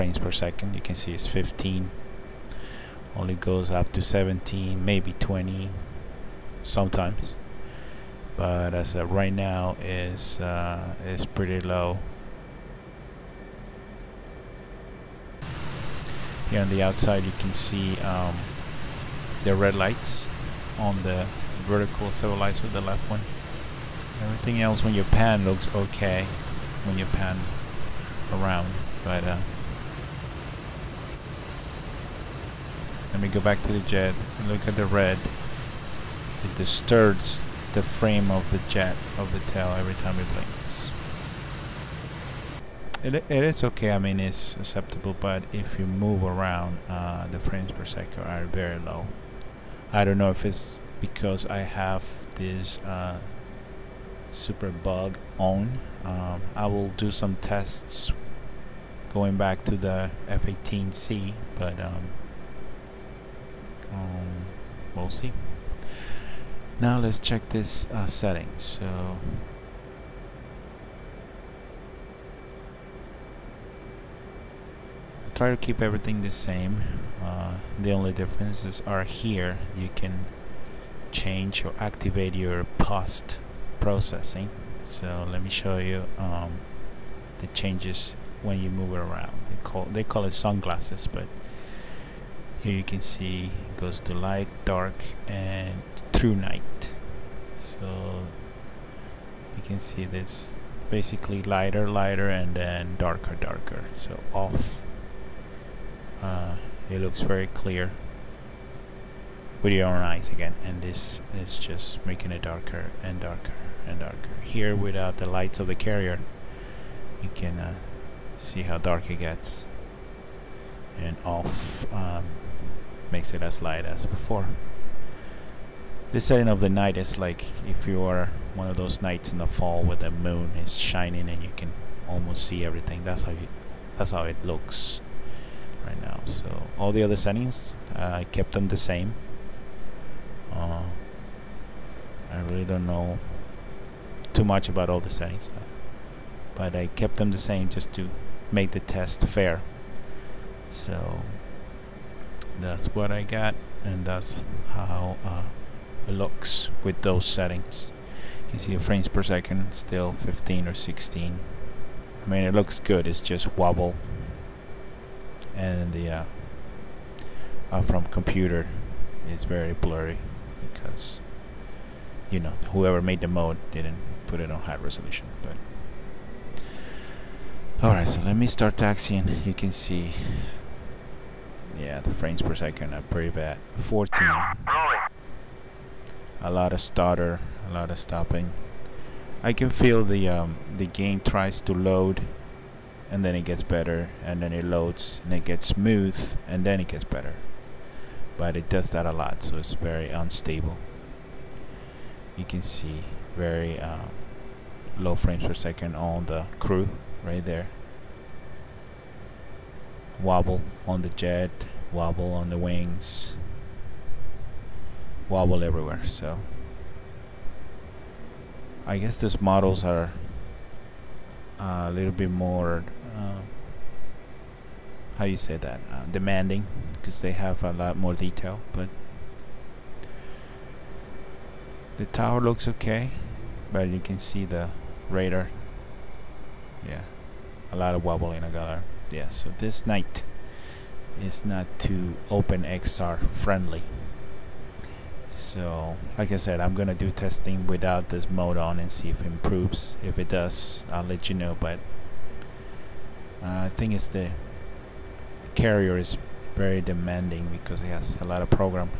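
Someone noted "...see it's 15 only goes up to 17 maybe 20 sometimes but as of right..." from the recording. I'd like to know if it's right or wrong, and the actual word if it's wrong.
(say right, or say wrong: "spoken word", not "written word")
right.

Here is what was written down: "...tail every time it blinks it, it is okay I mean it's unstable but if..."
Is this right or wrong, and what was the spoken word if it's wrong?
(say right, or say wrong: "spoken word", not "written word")
wrong: "acceptable", not "unstable".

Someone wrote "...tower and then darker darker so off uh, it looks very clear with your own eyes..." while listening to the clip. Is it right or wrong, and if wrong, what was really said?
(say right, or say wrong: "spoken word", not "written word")
wrong: "lighter", not "tower".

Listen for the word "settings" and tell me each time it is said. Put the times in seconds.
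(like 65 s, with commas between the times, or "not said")
68 s, 126 s, 137 s, 145 s, 157 s.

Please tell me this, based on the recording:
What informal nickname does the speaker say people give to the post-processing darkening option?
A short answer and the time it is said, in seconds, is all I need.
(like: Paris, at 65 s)
sunglasses, at 90 s.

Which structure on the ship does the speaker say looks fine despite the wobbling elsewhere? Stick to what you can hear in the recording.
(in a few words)
the tower.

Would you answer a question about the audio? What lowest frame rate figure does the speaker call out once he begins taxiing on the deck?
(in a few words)
14.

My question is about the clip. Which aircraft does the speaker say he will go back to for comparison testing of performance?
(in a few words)
F-18C.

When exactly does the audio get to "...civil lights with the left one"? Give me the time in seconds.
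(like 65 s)
22 s.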